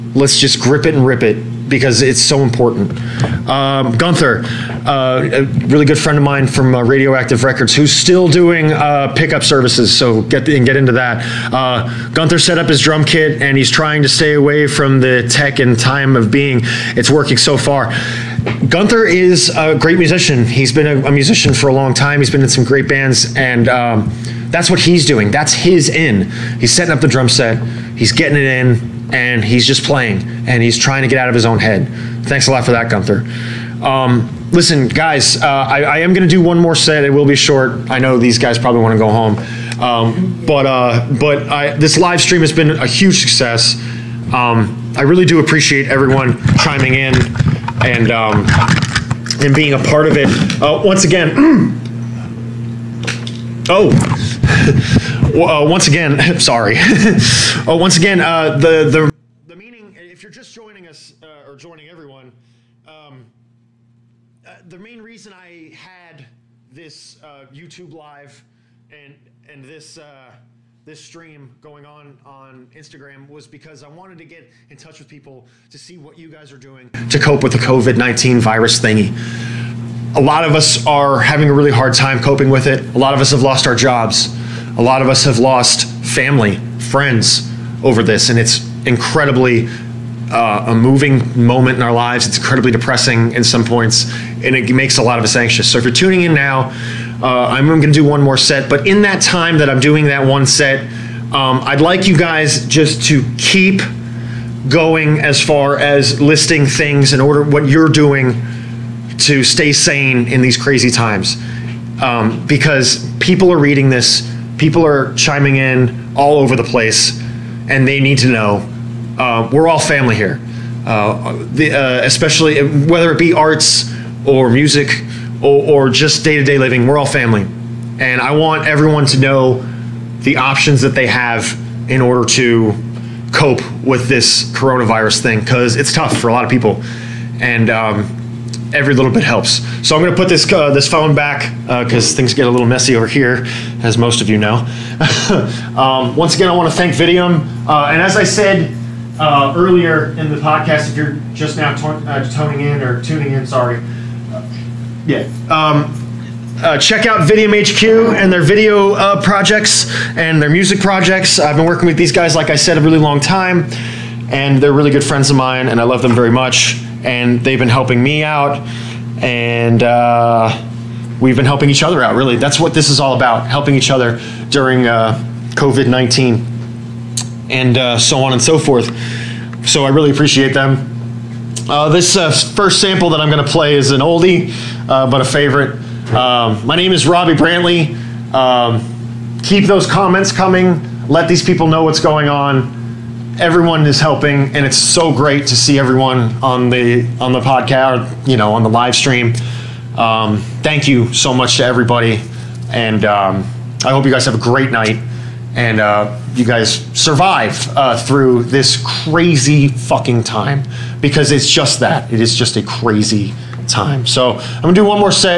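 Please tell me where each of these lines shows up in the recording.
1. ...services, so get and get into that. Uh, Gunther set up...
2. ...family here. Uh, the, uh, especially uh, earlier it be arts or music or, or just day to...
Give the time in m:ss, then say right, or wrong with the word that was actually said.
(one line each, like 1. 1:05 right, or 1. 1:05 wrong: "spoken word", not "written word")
1. 0:09 right
2. 1:59 wrong: "whether", not "earlier".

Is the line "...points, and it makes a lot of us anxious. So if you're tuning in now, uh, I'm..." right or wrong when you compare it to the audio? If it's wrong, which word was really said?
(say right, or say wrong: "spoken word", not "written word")
right.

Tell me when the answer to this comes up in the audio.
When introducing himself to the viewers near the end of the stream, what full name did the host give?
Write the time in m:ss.
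3:07.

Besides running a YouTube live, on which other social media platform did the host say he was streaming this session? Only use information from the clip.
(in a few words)
Instagram.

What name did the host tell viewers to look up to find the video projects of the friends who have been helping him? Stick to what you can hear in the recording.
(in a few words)
Vidium HQ.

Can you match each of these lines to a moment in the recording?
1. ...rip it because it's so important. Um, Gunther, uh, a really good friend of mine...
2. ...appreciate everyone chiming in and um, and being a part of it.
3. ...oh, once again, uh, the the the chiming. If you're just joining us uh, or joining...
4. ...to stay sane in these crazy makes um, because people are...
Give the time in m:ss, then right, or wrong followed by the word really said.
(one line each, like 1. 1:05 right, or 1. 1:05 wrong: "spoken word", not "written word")
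1. 0:01 right
2. 0:45 right
3. 0:57 wrong: "meaning", not "chiming"
4. 1:49 wrong: "times", not "makes".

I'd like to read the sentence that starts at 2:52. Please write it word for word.
Really, that's what this is all about: helping each other during uh, COVID nineteen, and uh, so on and so forth.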